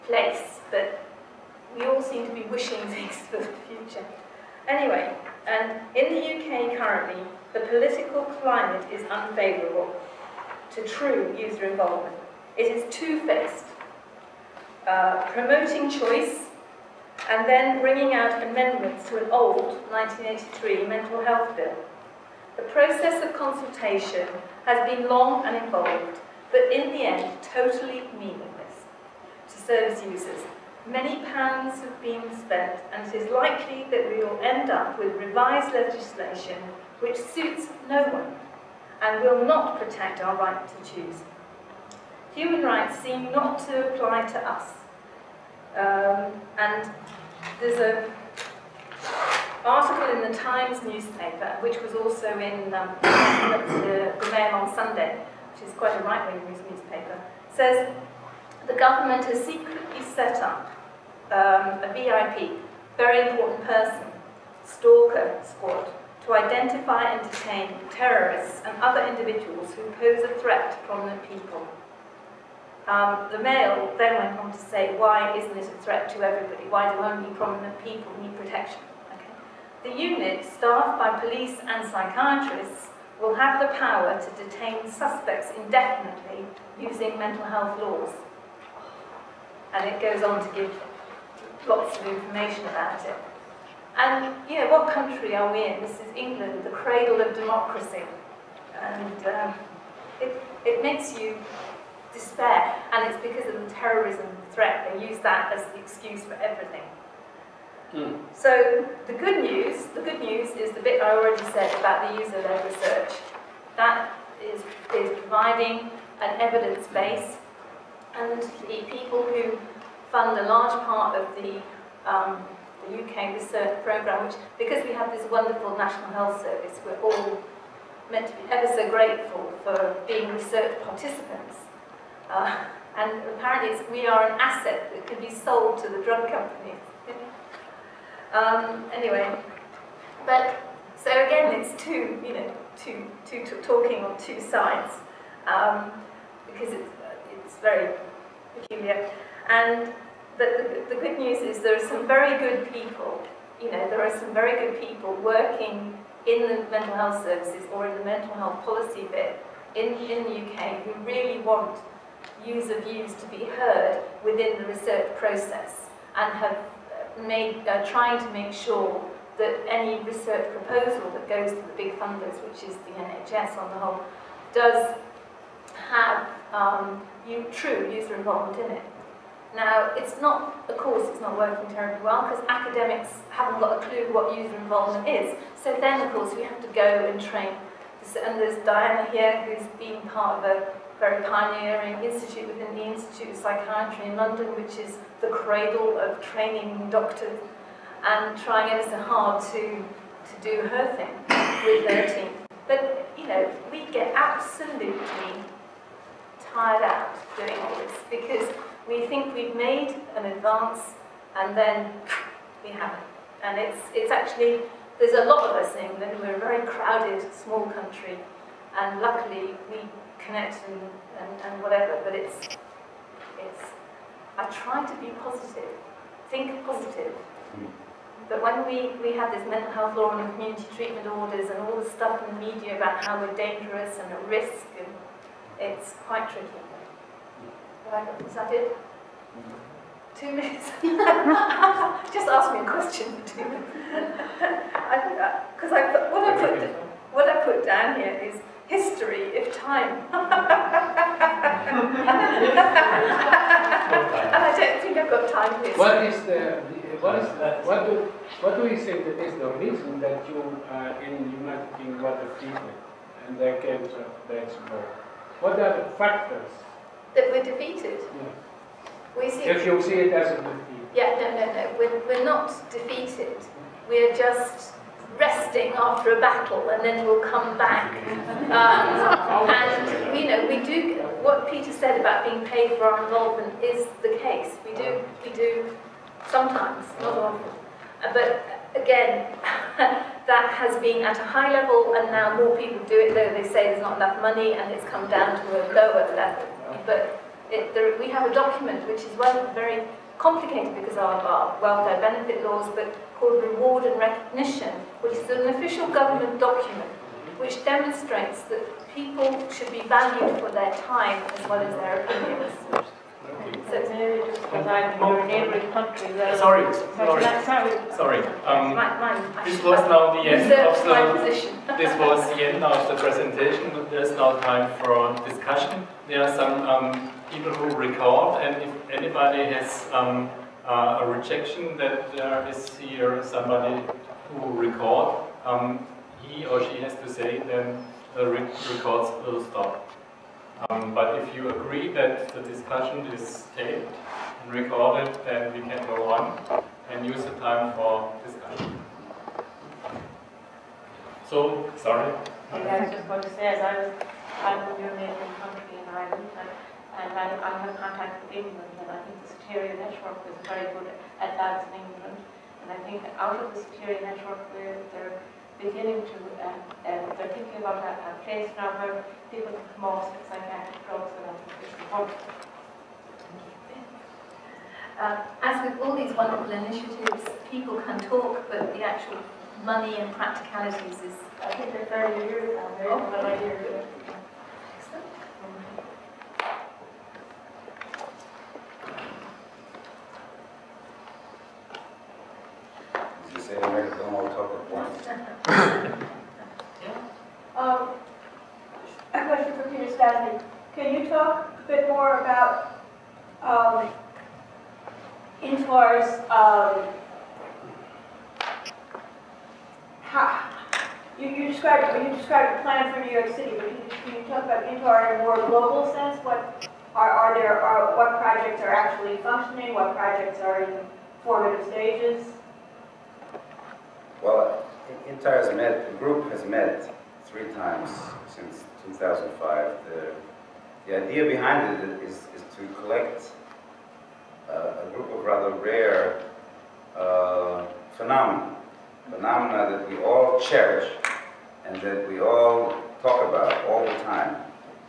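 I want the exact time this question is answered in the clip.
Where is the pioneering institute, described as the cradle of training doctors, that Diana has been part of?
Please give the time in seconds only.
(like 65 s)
192 s.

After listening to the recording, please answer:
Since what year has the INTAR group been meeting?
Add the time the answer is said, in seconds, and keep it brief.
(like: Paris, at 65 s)
2005, at 428 s.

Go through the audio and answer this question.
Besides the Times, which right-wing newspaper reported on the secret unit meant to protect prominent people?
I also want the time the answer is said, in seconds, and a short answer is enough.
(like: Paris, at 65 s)
Mail on Sunday, at 54 s.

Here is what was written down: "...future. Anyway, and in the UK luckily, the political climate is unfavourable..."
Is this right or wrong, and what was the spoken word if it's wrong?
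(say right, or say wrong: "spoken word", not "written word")
wrong: "currently", not "luckily".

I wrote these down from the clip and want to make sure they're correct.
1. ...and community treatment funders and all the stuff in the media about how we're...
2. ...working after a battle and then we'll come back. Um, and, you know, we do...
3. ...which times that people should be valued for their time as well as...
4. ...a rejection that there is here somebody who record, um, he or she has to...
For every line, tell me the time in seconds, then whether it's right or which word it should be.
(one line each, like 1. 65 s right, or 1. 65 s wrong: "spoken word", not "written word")
1. 230 s wrong: "orders", not "funders"
2. 275 s wrong: "resting", not "working"
3. 307 s wrong: "demonstrates", not "times"
4. 331 s right.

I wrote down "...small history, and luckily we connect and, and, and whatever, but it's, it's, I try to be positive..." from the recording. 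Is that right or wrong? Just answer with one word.
wrong.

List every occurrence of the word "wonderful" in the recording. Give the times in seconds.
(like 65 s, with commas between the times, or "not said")
125 s, 376 s.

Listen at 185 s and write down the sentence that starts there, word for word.
So then, of course, we have to go and train.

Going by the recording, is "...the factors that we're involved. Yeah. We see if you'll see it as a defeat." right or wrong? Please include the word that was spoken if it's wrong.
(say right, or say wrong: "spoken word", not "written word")
wrong: "defeated", not "involved".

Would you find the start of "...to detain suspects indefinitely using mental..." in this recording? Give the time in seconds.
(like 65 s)
84 s.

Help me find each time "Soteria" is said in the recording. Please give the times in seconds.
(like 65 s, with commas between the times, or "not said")
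359 s, 363 s.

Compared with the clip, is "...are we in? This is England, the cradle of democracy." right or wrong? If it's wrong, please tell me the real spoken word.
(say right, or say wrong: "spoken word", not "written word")
right.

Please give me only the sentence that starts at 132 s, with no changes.
Uh, and apparently we are an asset that can be sold to the drug companies.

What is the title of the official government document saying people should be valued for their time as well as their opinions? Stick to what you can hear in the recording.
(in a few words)
Reward and Recognition.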